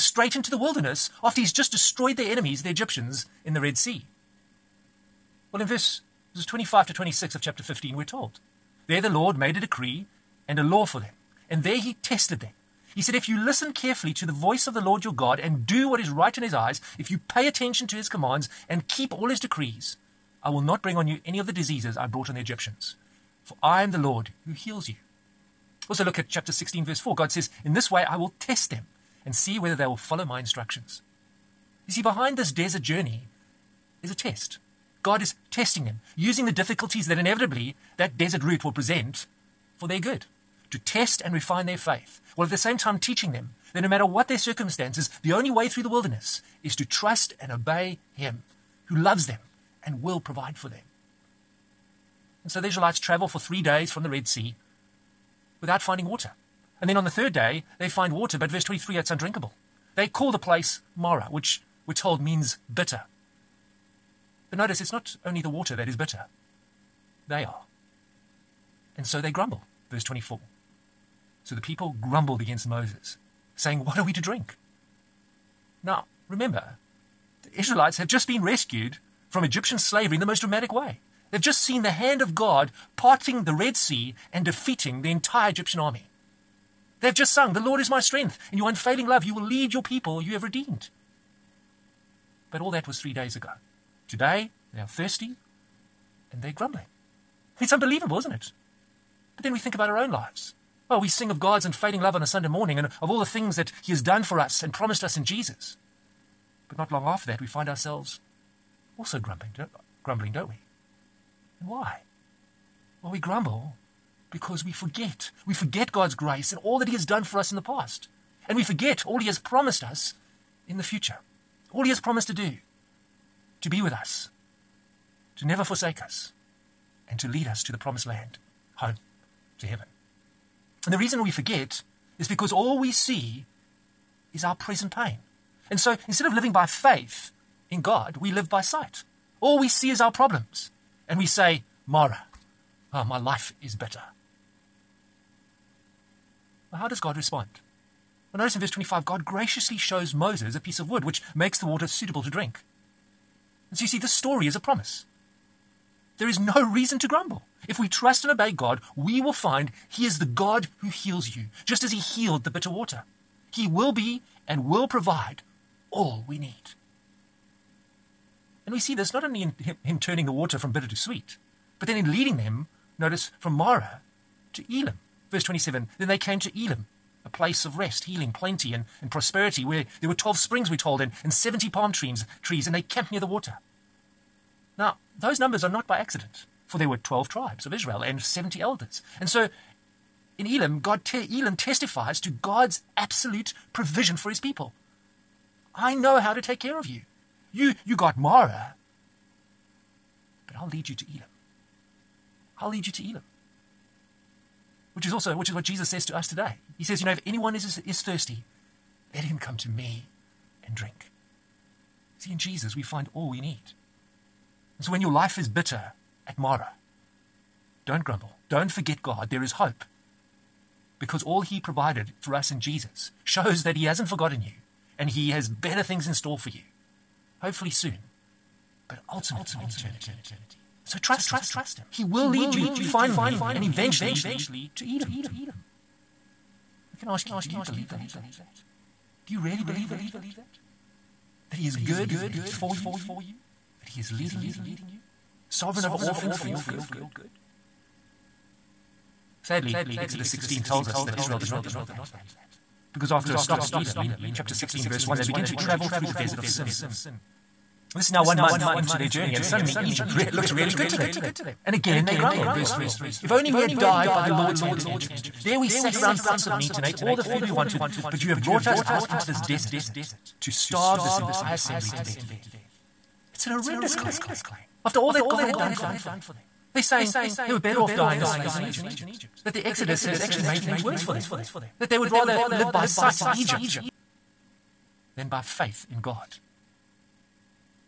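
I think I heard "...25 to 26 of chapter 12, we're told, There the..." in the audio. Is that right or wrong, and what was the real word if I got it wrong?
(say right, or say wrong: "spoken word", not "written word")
wrong: "15", not "12".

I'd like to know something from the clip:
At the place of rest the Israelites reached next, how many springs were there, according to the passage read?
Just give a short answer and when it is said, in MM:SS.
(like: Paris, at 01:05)
12, at 03:00.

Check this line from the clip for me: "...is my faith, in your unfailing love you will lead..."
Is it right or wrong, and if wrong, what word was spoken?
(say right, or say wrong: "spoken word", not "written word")
wrong: "strength", not "faith".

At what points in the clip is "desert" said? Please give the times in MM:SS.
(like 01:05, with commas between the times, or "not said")
00:32, 00:38, 04:16, 04:29.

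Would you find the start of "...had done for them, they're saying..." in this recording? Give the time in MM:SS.
04:35.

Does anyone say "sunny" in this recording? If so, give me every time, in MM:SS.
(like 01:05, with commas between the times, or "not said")
not said.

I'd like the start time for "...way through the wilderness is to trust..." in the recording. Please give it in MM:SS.
00:45.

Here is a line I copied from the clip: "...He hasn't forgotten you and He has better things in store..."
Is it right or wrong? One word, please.
right.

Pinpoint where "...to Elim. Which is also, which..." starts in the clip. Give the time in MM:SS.
03:22.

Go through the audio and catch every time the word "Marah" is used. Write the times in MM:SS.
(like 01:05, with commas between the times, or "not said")
01:00, 02:21, 02:53, 03:18, 03:36.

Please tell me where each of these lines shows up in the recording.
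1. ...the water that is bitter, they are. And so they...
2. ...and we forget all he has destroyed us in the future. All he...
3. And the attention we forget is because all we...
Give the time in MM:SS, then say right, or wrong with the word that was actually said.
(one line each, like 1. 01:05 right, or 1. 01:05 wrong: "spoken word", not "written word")
1. 01:05 right
2. 01:58 wrong: "promised", not "destroyed"
3. 02:10 wrong: "reason", not "attention".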